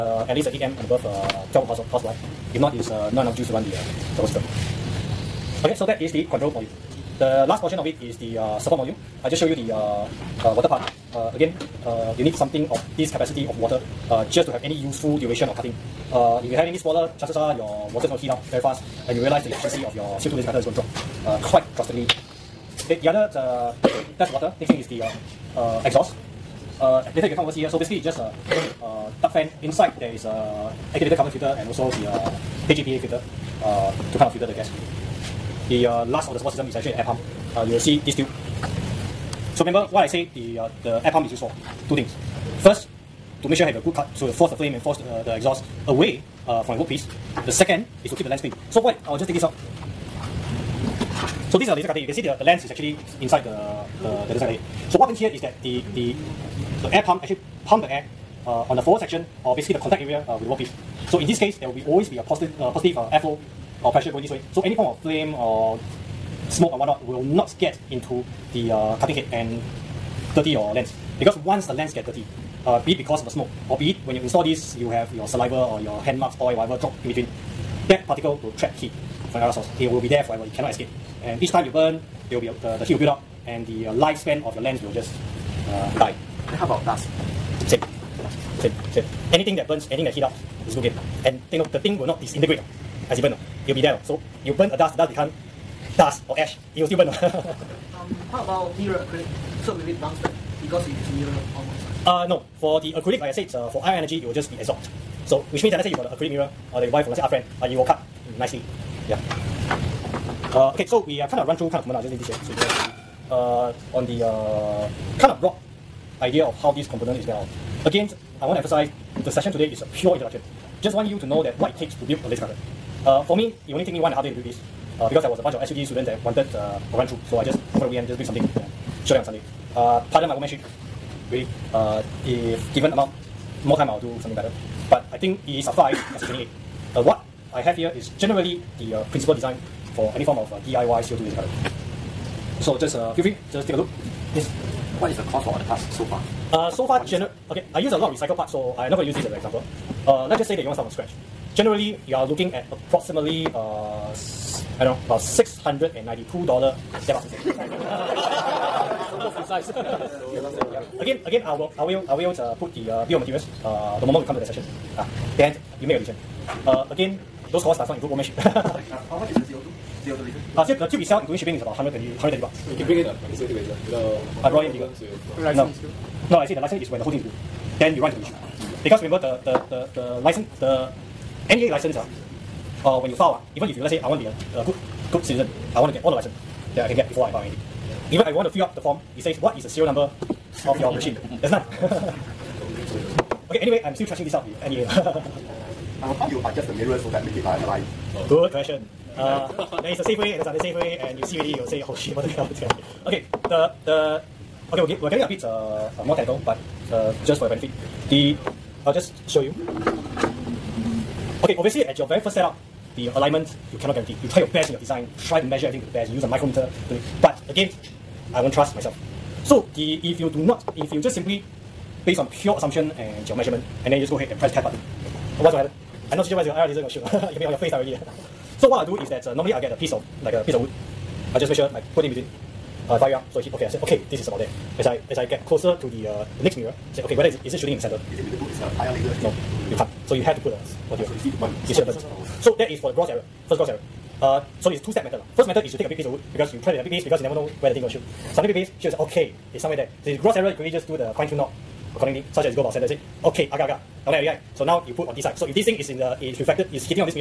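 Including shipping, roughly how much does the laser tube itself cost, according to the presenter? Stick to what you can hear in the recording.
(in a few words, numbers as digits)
120 bucks.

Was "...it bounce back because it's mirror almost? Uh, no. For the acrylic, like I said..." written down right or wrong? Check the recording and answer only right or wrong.
right.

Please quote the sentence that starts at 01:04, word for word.
So any form of flame or smoke or whatnot will not get into the uh, cutting head and dirty your lens.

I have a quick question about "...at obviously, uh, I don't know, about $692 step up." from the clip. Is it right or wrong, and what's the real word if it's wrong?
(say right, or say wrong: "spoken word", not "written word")
wrong: "approximately", not "obviously".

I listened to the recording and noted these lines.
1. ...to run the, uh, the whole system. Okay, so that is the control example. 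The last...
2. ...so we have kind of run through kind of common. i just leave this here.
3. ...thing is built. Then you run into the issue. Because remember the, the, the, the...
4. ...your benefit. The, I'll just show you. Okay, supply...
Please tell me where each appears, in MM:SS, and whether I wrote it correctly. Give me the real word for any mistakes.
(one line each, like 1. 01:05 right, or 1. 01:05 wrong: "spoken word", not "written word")
1. 00:03 wrong: "module", not "example"
2. 01:50 right
3. 02:57 right
4. 03:27 wrong: "obviously", not "supply".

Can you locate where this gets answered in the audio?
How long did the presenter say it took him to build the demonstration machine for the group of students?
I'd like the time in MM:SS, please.
02:03.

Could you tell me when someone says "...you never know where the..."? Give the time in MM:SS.
04:07.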